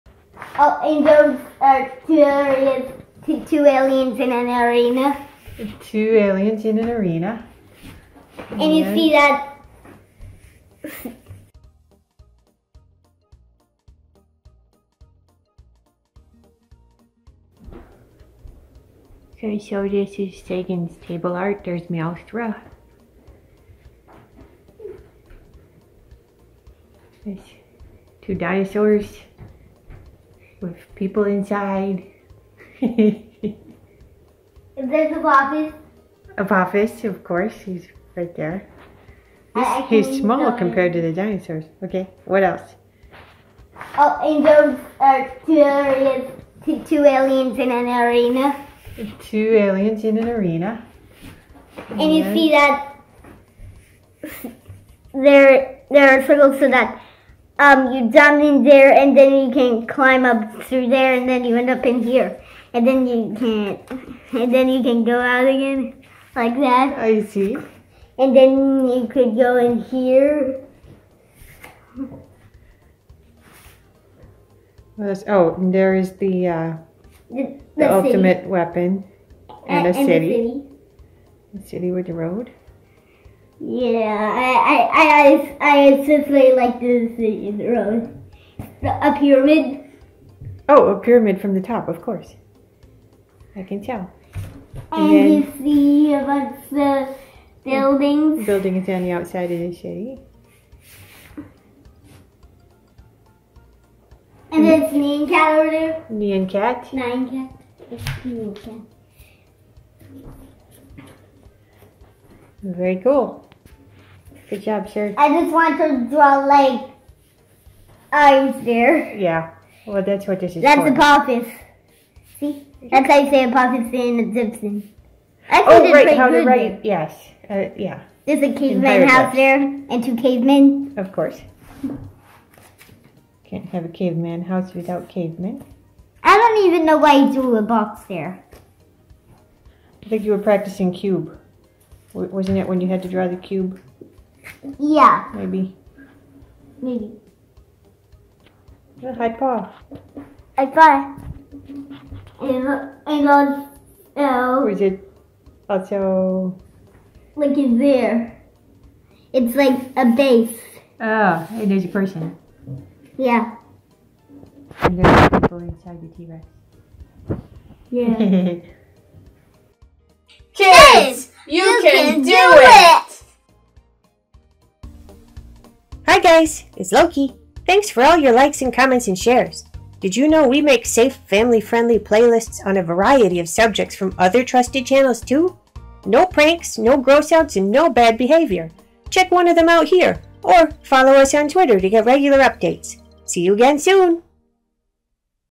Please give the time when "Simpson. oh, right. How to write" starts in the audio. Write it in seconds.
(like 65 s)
124 s.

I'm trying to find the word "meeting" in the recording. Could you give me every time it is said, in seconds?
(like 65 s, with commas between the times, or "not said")
not said.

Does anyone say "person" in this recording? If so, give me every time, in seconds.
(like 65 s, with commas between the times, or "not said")
161 s.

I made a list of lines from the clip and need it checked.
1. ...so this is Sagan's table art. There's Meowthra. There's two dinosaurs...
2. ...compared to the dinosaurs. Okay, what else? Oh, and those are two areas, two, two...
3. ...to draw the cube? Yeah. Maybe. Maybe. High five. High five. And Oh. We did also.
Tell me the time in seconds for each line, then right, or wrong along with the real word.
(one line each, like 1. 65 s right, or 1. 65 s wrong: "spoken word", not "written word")
1. 19 s right
2. 40 s right
3. 143 s right.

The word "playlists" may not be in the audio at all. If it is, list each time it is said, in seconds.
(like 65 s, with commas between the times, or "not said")
181 s.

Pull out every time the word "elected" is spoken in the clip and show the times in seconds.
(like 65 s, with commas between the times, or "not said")
not said.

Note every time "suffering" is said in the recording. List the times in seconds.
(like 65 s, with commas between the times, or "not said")
not said.